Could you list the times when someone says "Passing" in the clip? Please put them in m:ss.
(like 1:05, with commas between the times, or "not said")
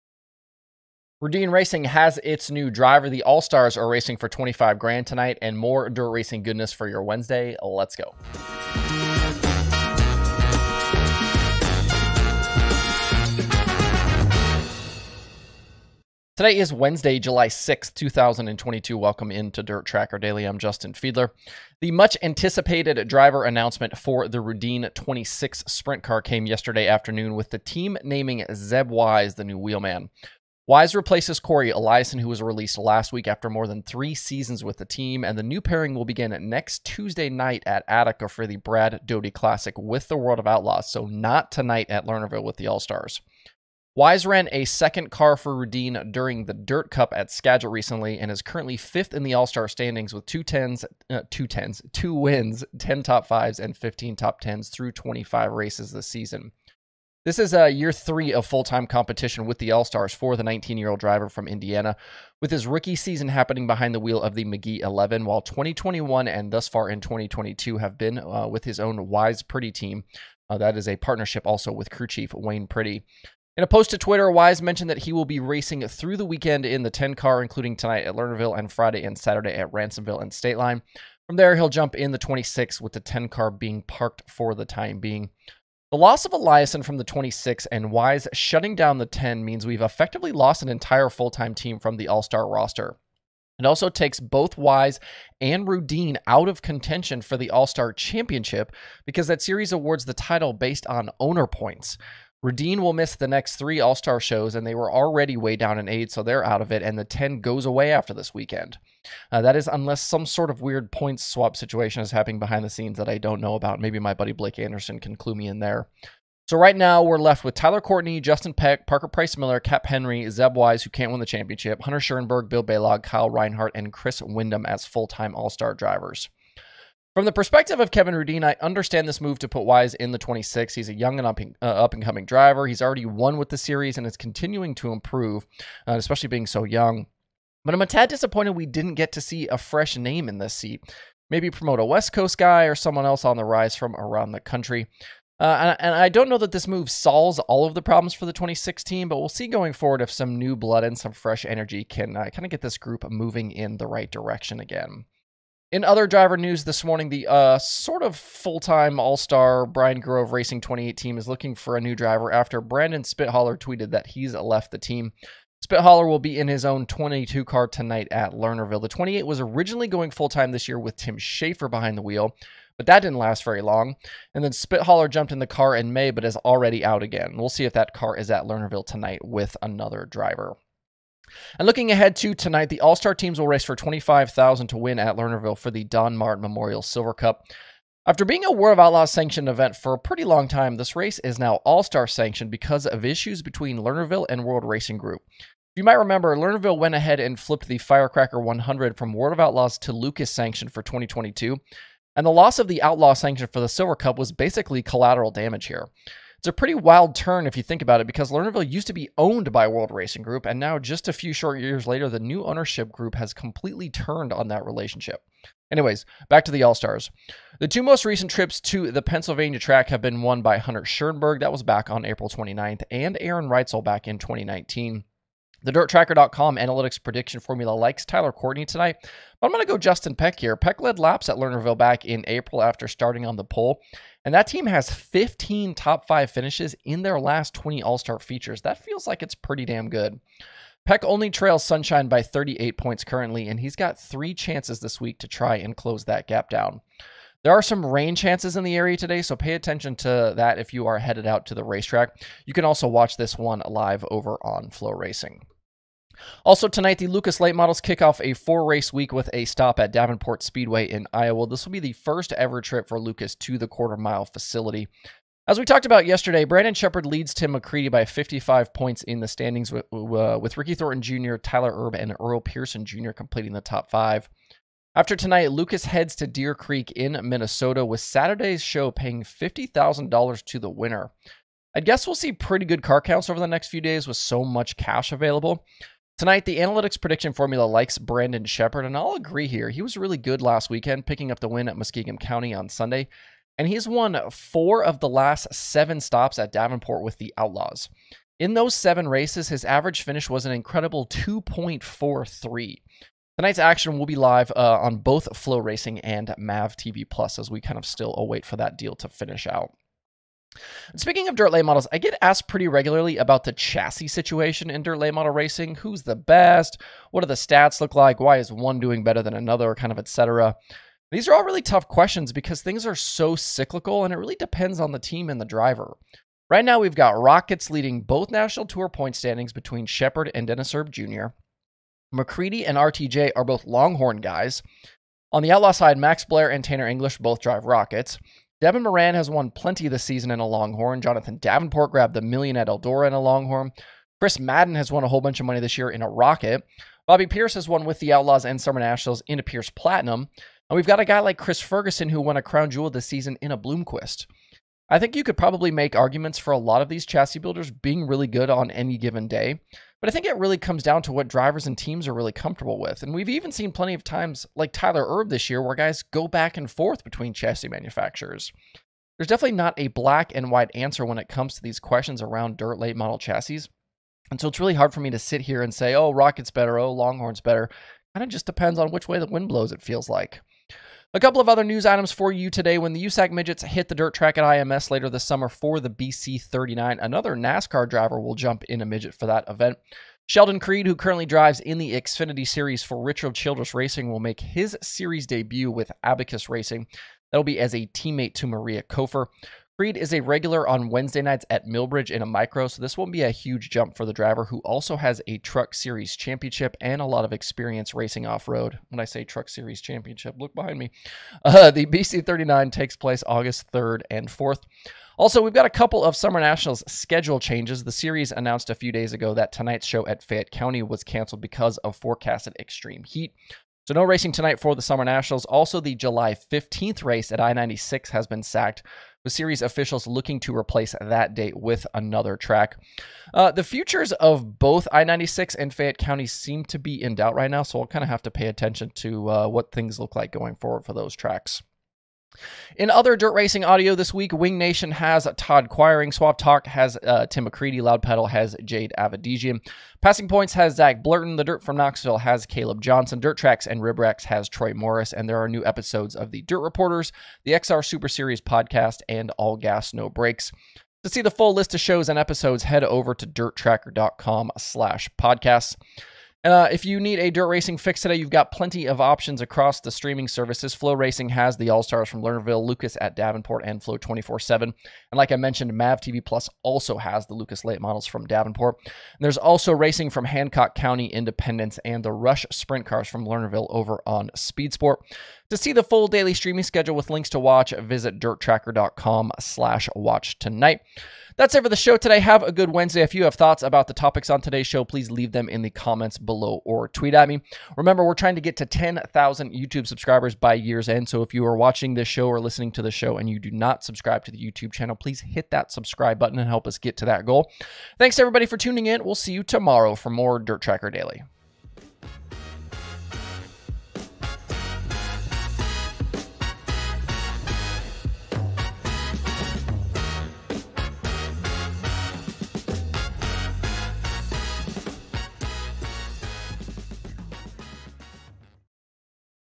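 7:30.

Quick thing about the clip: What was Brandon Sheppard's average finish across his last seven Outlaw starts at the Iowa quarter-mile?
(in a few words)
2.43.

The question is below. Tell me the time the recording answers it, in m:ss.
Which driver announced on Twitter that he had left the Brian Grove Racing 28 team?
2:42.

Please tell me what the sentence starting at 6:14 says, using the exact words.
And so it's really hard for me to sit here and say, oh, Rocket's better, oh, Longhorn's better.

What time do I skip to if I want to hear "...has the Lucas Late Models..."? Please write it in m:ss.
7:56.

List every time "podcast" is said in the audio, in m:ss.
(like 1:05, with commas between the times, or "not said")
7:38, 7:45.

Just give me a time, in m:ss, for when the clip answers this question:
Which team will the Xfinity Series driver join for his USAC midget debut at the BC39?
6:36.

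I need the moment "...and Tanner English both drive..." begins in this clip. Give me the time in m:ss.
5:36.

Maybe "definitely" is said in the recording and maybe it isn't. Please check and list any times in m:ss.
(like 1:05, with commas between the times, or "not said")
6:09.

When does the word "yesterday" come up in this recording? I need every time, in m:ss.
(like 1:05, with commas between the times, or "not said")
0:26, 4:26.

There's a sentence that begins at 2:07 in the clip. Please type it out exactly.
From the perspective of Kevin Rudeen, I understand this move to put Wise in the 26.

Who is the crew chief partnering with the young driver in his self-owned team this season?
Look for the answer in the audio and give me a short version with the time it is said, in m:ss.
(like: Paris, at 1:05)
Wayne Pretty, at 1:12.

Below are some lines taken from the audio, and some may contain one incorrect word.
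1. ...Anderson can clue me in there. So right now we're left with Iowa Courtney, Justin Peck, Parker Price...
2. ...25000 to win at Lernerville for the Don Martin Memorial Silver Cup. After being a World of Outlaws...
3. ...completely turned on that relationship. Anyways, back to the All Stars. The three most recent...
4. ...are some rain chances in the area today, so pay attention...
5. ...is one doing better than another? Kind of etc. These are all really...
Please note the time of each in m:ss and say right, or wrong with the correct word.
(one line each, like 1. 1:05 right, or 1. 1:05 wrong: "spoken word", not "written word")
1. 1:54 wrong: "Tyler", not "Iowa"
2. 3:03 right
3. 3:33 wrong: "two", not "three"
4. 4:07 right
5. 5:18 right.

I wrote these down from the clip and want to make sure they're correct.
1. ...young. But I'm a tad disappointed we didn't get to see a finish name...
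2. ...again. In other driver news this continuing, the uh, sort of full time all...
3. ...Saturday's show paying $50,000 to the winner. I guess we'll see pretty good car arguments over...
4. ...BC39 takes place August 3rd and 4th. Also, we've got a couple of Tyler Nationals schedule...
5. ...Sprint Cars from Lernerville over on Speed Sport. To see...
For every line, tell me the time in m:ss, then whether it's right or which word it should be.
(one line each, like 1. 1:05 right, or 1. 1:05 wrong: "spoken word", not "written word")
1. 2:16 wrong: "fresh", not "finish"
2. 2:34 wrong: "morning", not "continuing"
3. 4:38 wrong: "counts", not "arguments"
4. 6:51 wrong: "Summer", not "Tyler"
5. 8:02 right.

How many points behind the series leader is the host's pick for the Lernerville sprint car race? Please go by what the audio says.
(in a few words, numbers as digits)
38.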